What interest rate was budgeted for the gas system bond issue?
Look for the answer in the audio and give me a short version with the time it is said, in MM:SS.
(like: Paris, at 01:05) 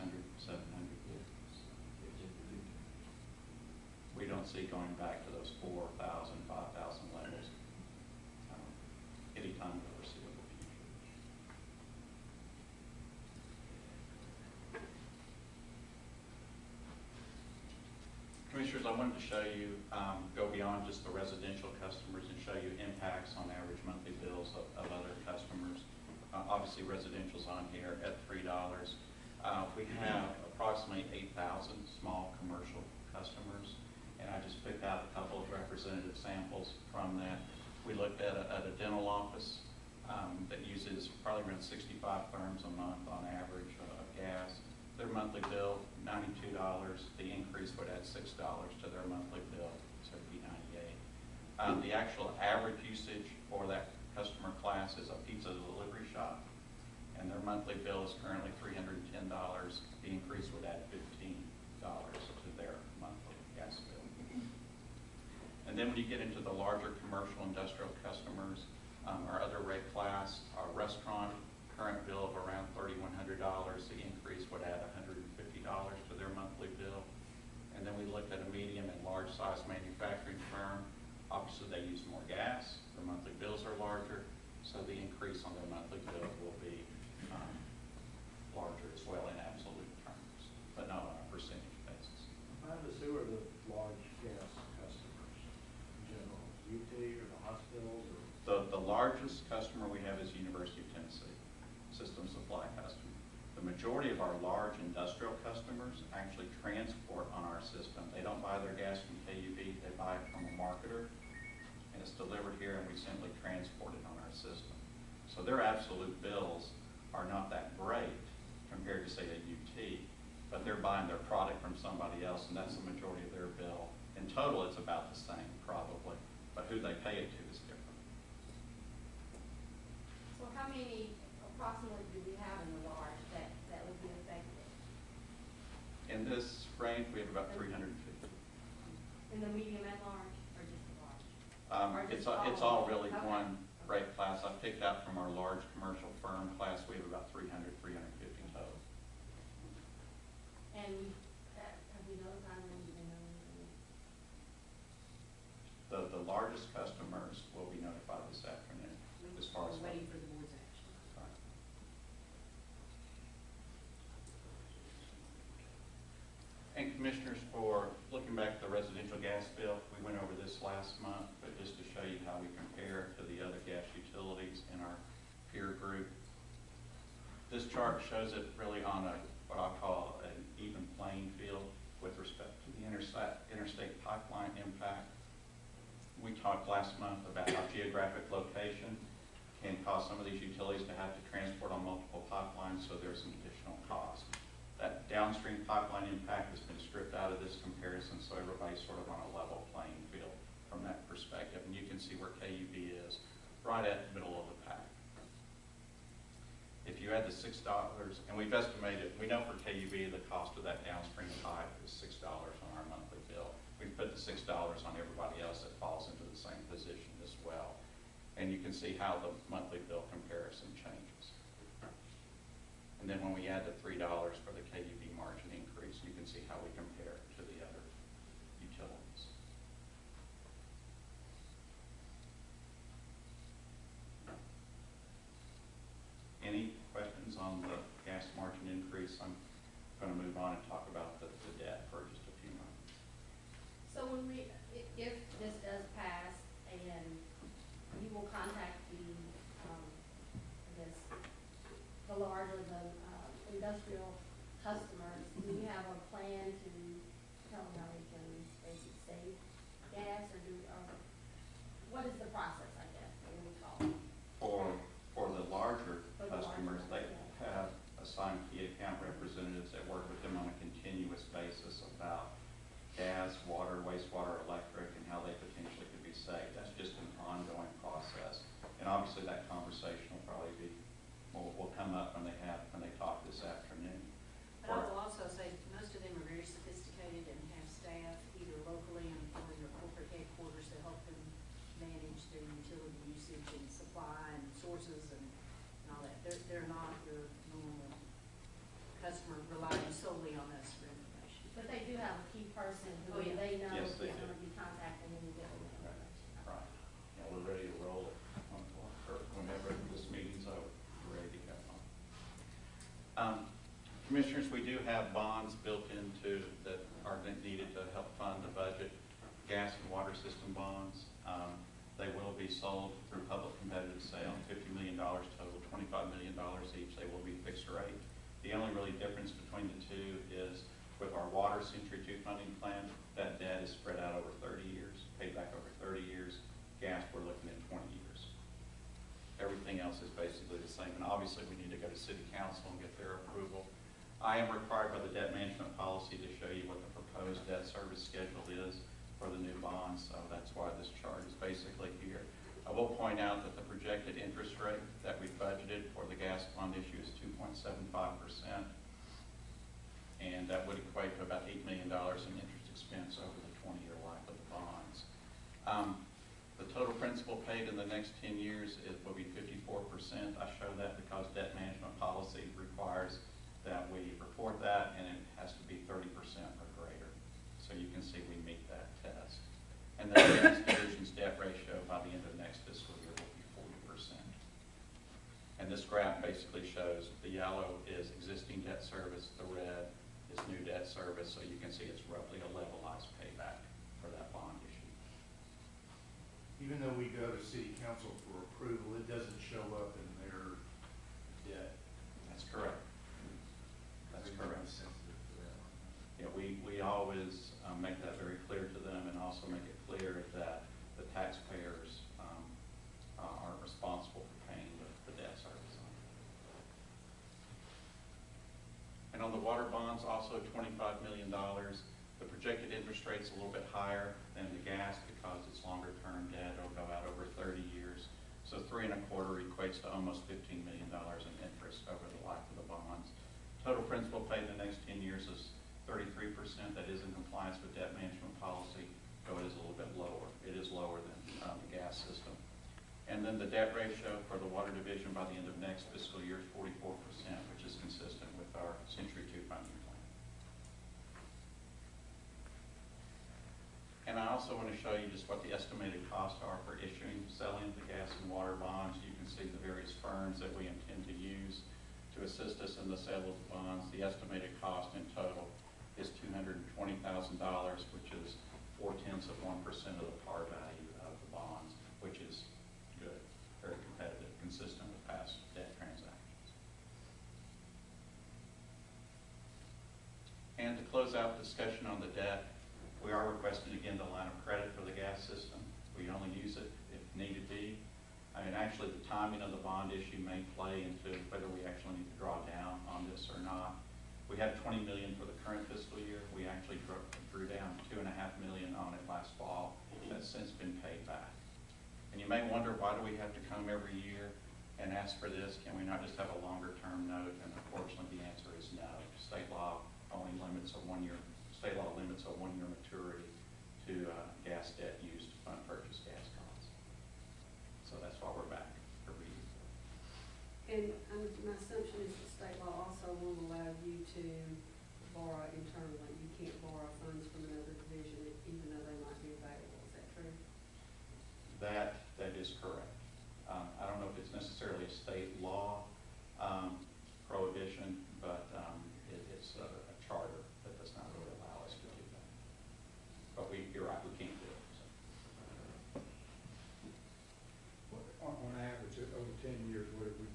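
2.75%, at 05:57.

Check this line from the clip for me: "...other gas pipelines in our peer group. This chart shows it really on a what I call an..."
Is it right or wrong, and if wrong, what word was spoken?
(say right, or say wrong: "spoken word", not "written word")
wrong: "utilities", not "pipelines".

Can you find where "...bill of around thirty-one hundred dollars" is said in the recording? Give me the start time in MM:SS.
01:12.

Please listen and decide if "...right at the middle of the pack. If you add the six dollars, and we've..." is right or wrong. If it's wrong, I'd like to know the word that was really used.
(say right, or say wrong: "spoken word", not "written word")
right.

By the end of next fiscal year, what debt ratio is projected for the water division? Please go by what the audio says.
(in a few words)
44%.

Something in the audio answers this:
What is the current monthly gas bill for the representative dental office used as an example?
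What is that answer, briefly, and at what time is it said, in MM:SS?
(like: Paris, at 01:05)
$92, at 00:46.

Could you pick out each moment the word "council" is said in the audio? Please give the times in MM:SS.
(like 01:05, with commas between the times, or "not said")
05:42, 06:37.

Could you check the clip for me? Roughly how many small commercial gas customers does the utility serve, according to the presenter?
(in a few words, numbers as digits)
8,000.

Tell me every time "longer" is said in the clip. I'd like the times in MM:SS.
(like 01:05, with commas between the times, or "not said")
07:05, 08:26.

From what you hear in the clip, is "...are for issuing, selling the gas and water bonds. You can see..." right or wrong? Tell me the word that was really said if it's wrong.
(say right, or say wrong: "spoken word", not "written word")
right.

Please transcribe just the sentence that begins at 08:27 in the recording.
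And unfortunately, the answer is no.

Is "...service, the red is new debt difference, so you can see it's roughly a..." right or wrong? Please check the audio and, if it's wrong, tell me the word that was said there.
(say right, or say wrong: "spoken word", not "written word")
wrong: "service", not "difference".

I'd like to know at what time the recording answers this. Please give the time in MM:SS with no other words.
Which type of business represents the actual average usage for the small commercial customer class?
00:55.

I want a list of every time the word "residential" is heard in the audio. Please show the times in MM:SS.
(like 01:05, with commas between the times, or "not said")
00:21, 00:26, 02:48.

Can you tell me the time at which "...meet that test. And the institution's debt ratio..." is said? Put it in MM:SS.
06:18.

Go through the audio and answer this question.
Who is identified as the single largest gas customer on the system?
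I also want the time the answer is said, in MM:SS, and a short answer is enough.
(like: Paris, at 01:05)
University of Tennessee, at 01:40.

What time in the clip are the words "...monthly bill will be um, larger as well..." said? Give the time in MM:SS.
01:25.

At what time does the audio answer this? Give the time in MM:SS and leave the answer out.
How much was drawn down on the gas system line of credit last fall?
08:17.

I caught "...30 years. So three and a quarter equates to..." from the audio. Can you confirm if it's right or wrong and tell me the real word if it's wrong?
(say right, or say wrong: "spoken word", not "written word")
right.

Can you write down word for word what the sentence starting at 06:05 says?
Um, the total principal paid in the next 10 years will be 54%.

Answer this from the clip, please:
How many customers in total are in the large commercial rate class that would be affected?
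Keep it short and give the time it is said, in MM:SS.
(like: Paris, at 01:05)
350, at 02:27.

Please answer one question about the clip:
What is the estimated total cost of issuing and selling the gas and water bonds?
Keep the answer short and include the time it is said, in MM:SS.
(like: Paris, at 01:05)
$220,000, at 07:46.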